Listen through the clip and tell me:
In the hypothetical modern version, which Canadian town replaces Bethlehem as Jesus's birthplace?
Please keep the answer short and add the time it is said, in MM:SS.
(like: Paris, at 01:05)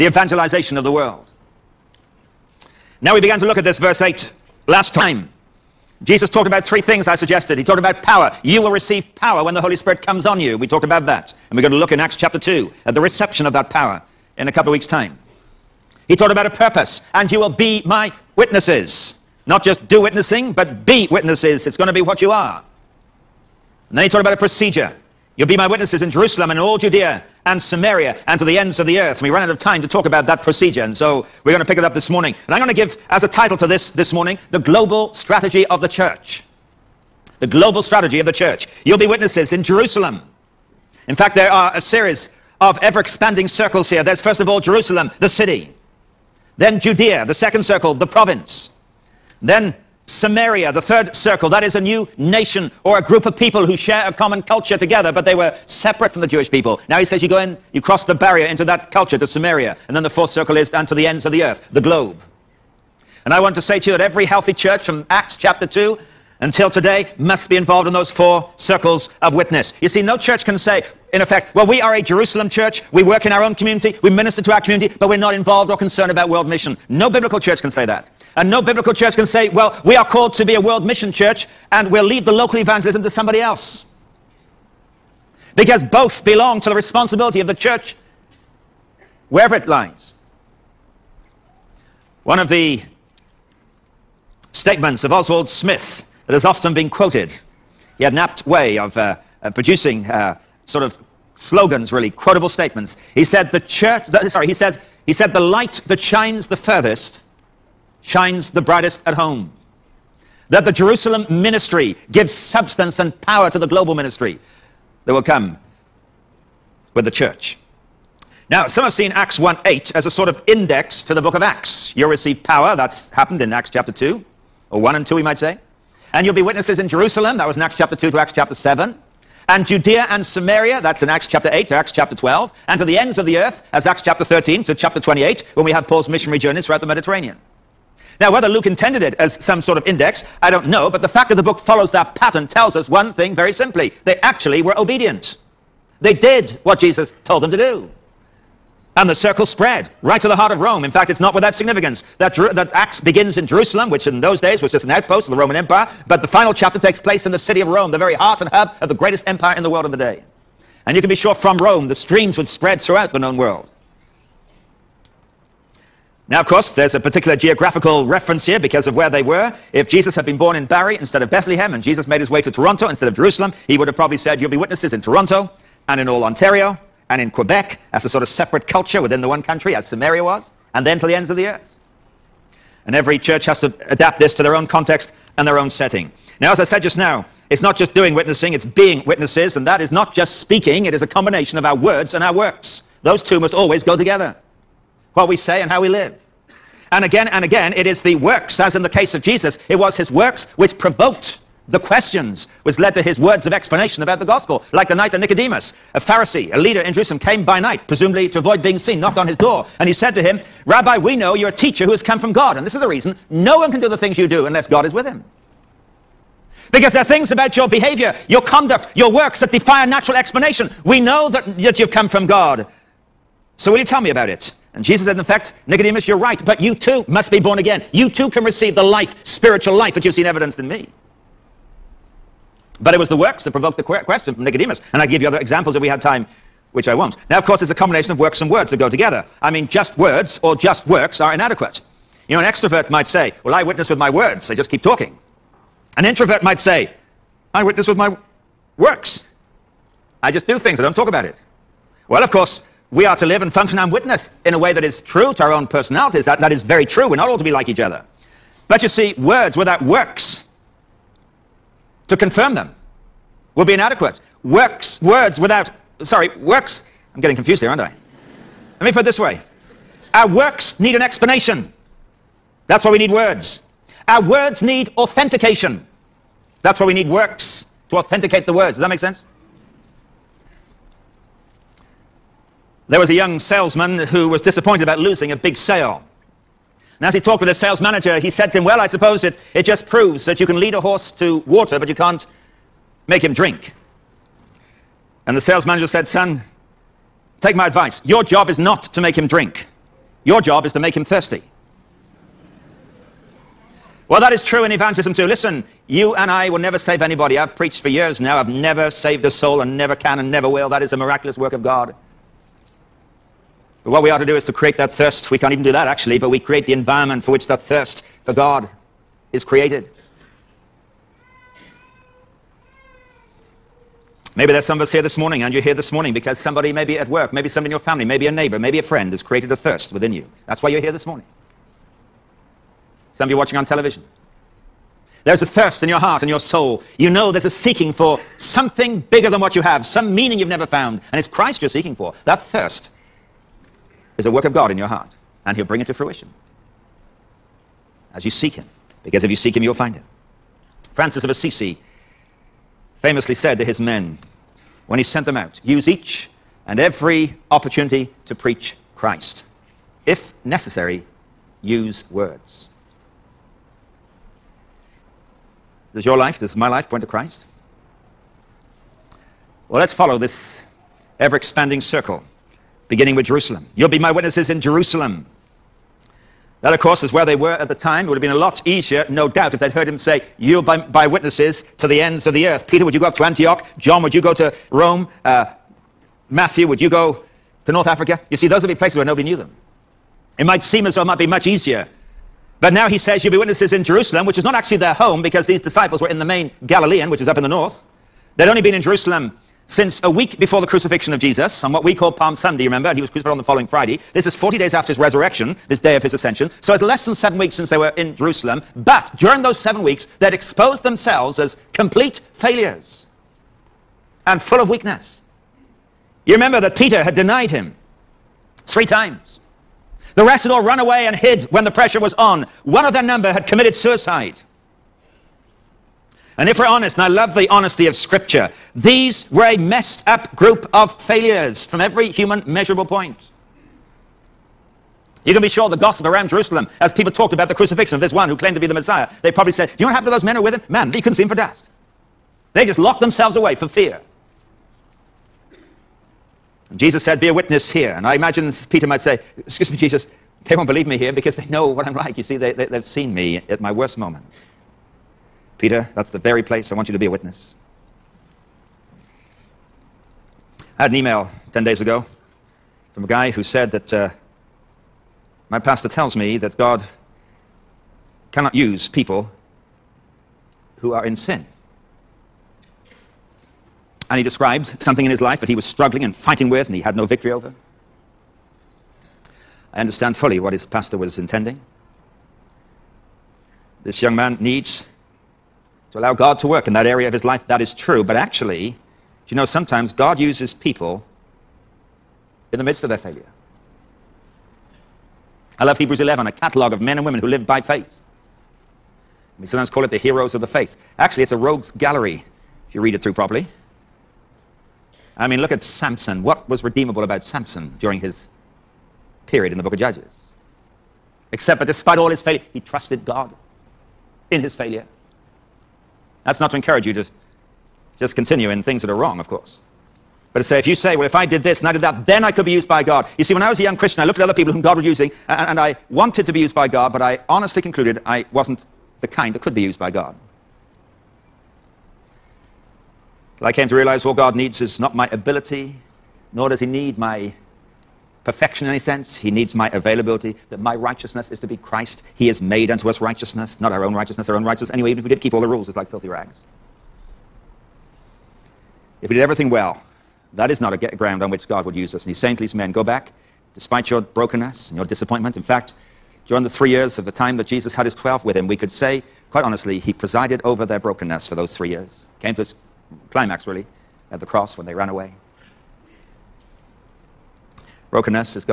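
Barrie, at 02:50.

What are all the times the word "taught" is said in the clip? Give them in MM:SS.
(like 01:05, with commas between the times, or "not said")
00:16, 00:24.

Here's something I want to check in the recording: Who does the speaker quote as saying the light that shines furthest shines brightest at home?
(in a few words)
Oswald Smith.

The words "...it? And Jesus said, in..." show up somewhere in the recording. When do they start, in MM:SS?
03:44.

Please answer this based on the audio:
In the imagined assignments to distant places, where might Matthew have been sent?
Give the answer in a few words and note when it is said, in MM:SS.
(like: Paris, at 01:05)
North Africa, at 06:27.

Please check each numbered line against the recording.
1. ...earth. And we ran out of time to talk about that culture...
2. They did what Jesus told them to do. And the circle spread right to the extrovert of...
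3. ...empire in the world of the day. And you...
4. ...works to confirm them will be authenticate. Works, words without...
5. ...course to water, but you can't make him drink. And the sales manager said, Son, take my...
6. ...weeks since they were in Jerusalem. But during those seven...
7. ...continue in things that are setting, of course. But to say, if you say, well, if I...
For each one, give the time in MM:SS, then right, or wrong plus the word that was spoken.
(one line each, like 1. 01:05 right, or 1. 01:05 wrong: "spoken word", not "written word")
1. 00:28 wrong: "procedure", not "culture"
2. 02:26 wrong: "heart", not "extrovert"
3. 02:39 right
4. 04:19 wrong: "inadequate", not "authenticate"
5. 04:50 wrong: "horse", not "course"
6. 06:47 right
7. 08:38 wrong: "wrong", not "setting".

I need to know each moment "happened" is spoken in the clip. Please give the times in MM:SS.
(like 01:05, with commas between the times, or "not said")
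02:03, 07:19.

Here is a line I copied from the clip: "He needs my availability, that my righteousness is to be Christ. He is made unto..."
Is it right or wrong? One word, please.
right.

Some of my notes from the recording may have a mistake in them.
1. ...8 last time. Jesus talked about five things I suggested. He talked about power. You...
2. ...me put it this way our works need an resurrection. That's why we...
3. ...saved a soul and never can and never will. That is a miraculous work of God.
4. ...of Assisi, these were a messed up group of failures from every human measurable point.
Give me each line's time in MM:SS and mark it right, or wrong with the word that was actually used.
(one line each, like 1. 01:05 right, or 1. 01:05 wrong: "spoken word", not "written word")
1. 00:03 wrong: "three", not "five"
2. 04:28 wrong: "explanation", not "resurrection"
3. 05:08 right
4. 07:07 wrong: "Scripture", not "Assisi".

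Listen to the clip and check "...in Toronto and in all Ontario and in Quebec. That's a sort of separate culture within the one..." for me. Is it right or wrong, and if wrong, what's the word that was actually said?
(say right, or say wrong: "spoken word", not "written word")
right.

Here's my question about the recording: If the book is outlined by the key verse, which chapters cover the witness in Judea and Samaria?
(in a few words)
Acts 8 to 12.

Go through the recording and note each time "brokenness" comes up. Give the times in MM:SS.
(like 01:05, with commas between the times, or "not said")
09:13, 09:20, 09:27.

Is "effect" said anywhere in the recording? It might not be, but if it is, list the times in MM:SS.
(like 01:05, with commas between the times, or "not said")
01:11, 03:45.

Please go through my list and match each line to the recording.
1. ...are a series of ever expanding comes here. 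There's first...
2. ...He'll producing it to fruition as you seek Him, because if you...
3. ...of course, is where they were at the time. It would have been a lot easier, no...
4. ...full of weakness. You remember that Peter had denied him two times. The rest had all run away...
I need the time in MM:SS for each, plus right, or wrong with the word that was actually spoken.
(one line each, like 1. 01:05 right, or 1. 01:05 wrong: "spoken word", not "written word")
1. 00:41 wrong: "circles", not "comes"
2. 05:45 wrong: "bring", not "producing"
3. 06:16 right
4. 06:54 wrong: "three", not "two".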